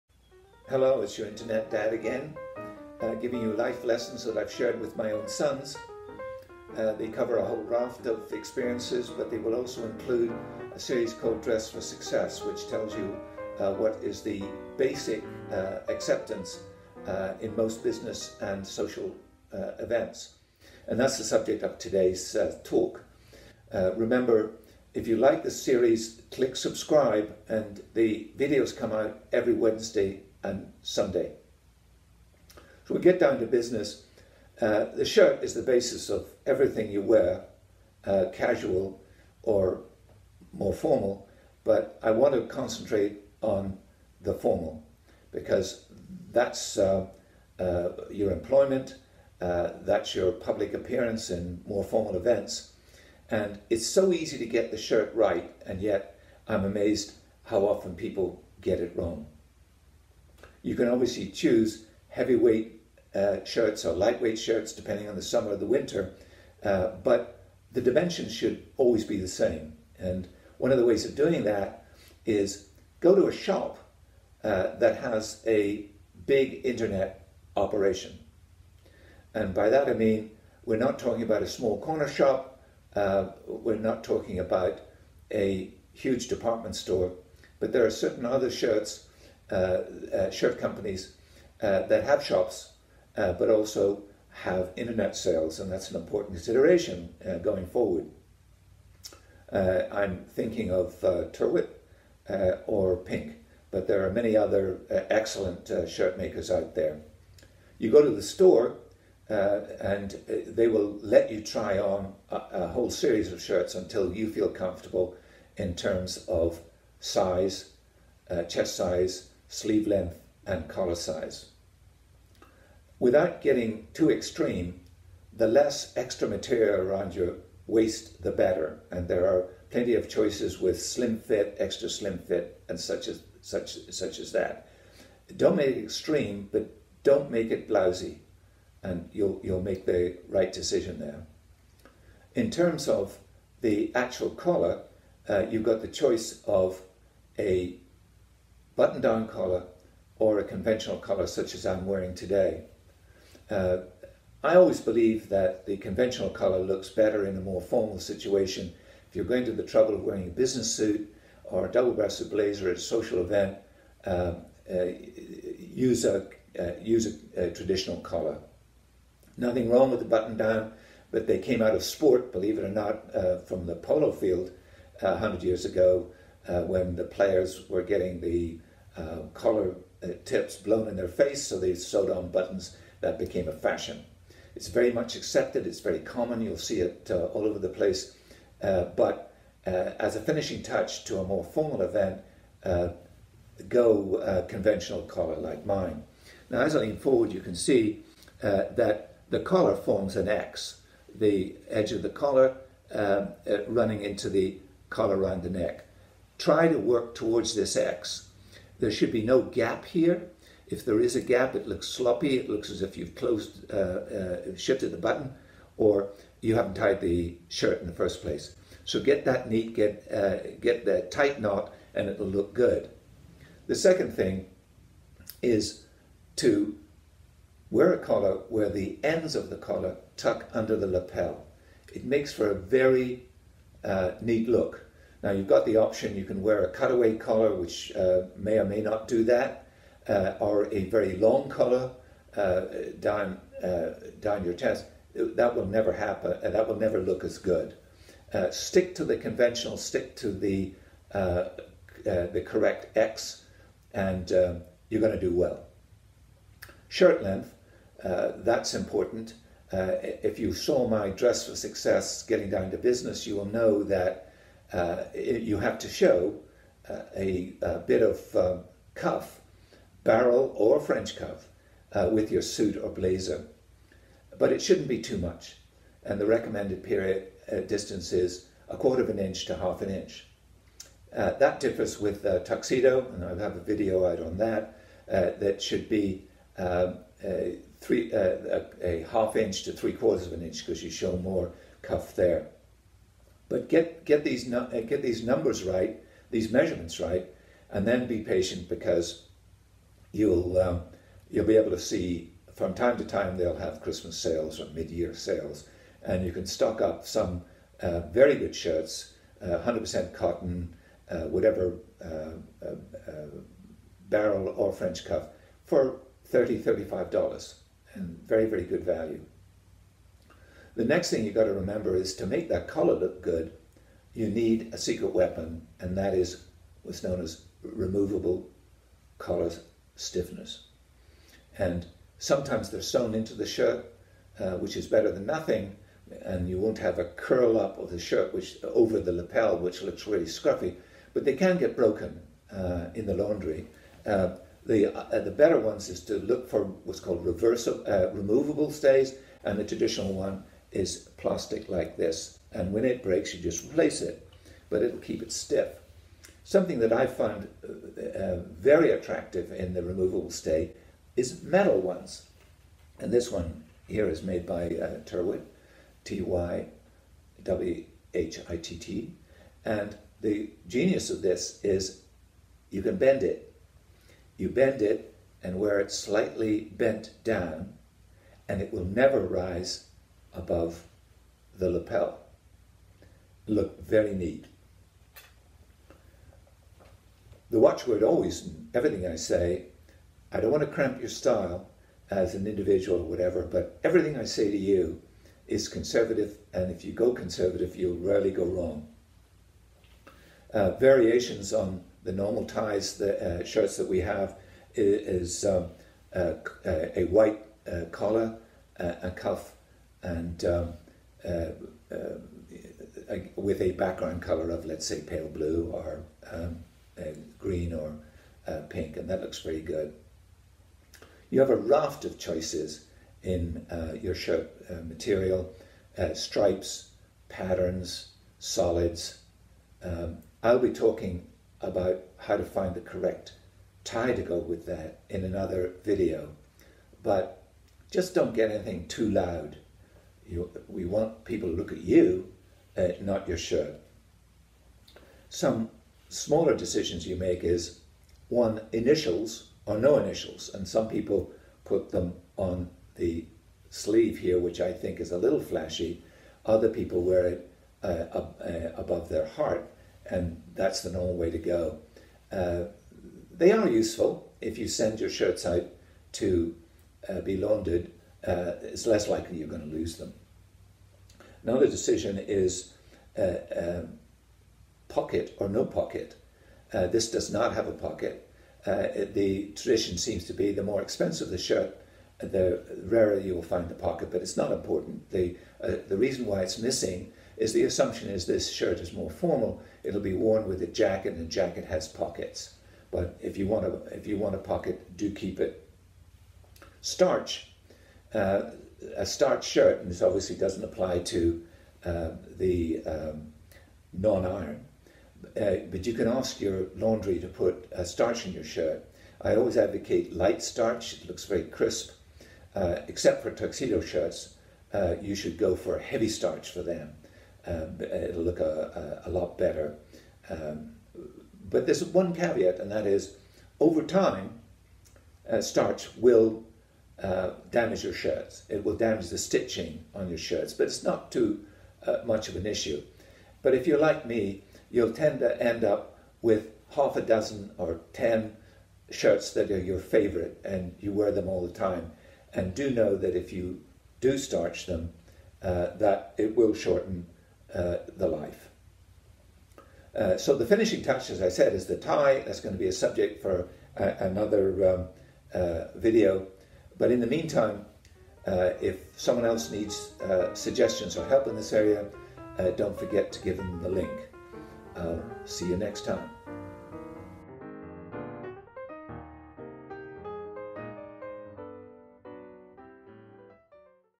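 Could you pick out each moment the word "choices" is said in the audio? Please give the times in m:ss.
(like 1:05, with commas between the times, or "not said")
2:10, 2:25, 7:02.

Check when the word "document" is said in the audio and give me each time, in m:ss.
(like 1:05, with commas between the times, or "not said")
not said.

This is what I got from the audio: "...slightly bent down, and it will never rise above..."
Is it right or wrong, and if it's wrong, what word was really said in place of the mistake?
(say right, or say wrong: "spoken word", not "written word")
right.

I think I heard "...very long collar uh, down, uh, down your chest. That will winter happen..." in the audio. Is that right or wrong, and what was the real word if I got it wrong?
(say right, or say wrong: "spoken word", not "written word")
wrong: "never", not "winter".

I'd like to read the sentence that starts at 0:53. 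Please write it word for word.
And it's so easy to get the shirt right, and yet I'm amazed how often people get it wrong.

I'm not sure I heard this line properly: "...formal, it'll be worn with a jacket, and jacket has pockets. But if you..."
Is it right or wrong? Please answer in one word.
right.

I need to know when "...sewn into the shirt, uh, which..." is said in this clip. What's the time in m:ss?
5:32.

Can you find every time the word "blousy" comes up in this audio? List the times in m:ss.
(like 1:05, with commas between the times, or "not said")
2:17.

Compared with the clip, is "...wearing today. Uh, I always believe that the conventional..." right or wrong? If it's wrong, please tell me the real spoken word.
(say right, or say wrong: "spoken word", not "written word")
right.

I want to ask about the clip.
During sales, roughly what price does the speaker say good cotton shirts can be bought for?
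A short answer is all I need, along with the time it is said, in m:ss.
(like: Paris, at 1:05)
$30-35, at 5:16.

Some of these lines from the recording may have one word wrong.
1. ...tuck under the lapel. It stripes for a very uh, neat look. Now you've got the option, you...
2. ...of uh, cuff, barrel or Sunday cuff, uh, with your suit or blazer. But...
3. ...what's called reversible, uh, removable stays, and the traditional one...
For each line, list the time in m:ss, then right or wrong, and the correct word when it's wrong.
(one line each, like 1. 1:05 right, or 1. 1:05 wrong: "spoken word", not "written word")
1. 3:50 wrong: "makes", not "stripes"
2. 4:28 wrong: "French", not "Sunday"
3. 5:46 right.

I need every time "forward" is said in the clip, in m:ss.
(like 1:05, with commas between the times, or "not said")
1:37, 3:16.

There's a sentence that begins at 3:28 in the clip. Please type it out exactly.
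There should be no gap here.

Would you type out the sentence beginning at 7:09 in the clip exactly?
Um, I'll be talking about how to find the correct tie to go with that in another video.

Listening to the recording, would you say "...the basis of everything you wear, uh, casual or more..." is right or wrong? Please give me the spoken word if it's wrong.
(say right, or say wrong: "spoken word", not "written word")
right.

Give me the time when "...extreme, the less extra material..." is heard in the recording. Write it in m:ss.
2:04.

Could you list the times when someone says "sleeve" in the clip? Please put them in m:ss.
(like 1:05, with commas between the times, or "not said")
1:59, 7:33.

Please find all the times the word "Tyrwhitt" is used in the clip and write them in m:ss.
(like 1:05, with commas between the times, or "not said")
1:41, 6:05.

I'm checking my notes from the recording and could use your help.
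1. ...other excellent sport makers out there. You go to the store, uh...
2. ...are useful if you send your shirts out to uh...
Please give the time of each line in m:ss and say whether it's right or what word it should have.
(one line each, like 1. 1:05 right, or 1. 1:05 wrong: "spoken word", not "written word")
1. 1:44 wrong: "shirt", not "sport"
2. 7:43 right.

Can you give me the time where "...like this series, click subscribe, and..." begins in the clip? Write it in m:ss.
0:25.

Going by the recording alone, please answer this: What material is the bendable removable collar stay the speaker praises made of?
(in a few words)
Metal.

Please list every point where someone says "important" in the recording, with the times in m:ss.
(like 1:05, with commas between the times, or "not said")
1:35, 4:18, 8:04.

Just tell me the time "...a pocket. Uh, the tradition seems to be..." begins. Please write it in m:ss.
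7:57.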